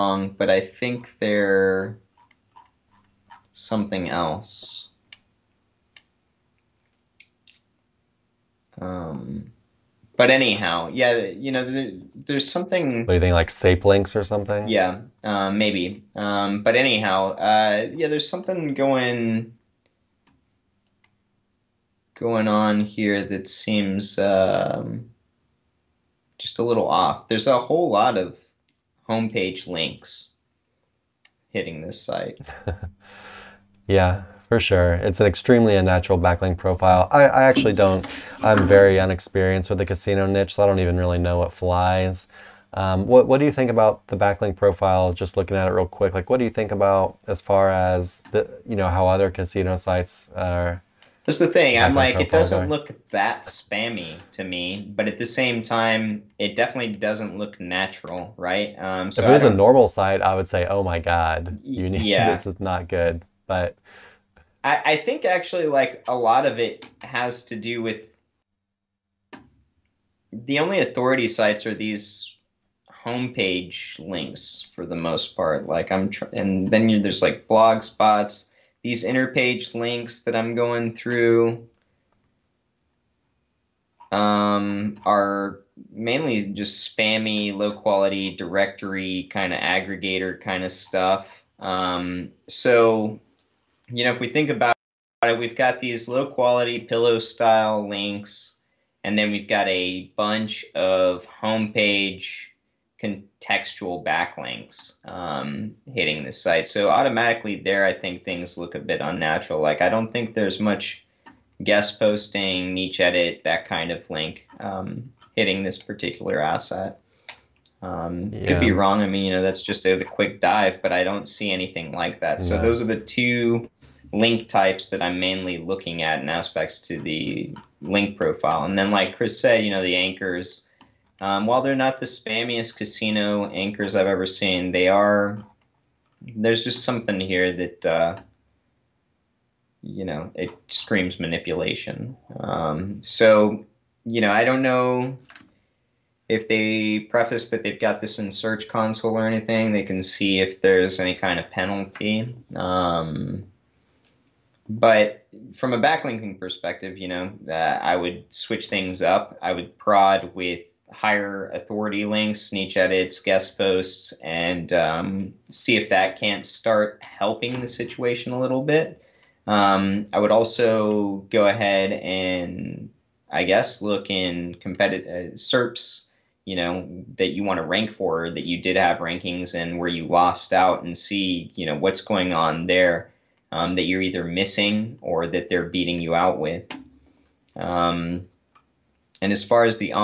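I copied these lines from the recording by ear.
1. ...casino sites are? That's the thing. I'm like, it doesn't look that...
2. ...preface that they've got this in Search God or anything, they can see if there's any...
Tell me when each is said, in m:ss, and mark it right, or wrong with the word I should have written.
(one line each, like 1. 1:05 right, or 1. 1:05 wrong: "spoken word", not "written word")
1. 0:49 right
2. 2:26 wrong: "Console", not "God".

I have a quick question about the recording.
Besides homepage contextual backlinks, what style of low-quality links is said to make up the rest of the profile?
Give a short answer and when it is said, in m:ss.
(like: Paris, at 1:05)
Pillow style links, at 1:36.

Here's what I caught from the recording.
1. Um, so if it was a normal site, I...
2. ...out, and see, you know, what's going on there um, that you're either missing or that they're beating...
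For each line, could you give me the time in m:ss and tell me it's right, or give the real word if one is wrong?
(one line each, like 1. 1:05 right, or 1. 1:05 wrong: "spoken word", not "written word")
1. 0:58 right
2. 3:00 right.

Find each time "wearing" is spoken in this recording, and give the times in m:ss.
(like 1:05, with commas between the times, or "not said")
not said.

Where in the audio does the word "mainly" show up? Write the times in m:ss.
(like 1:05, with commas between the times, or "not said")
1:25, 2:05.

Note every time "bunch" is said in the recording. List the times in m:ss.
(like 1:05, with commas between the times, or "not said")
1:40.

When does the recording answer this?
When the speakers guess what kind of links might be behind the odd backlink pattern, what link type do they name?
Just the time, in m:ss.
0:13.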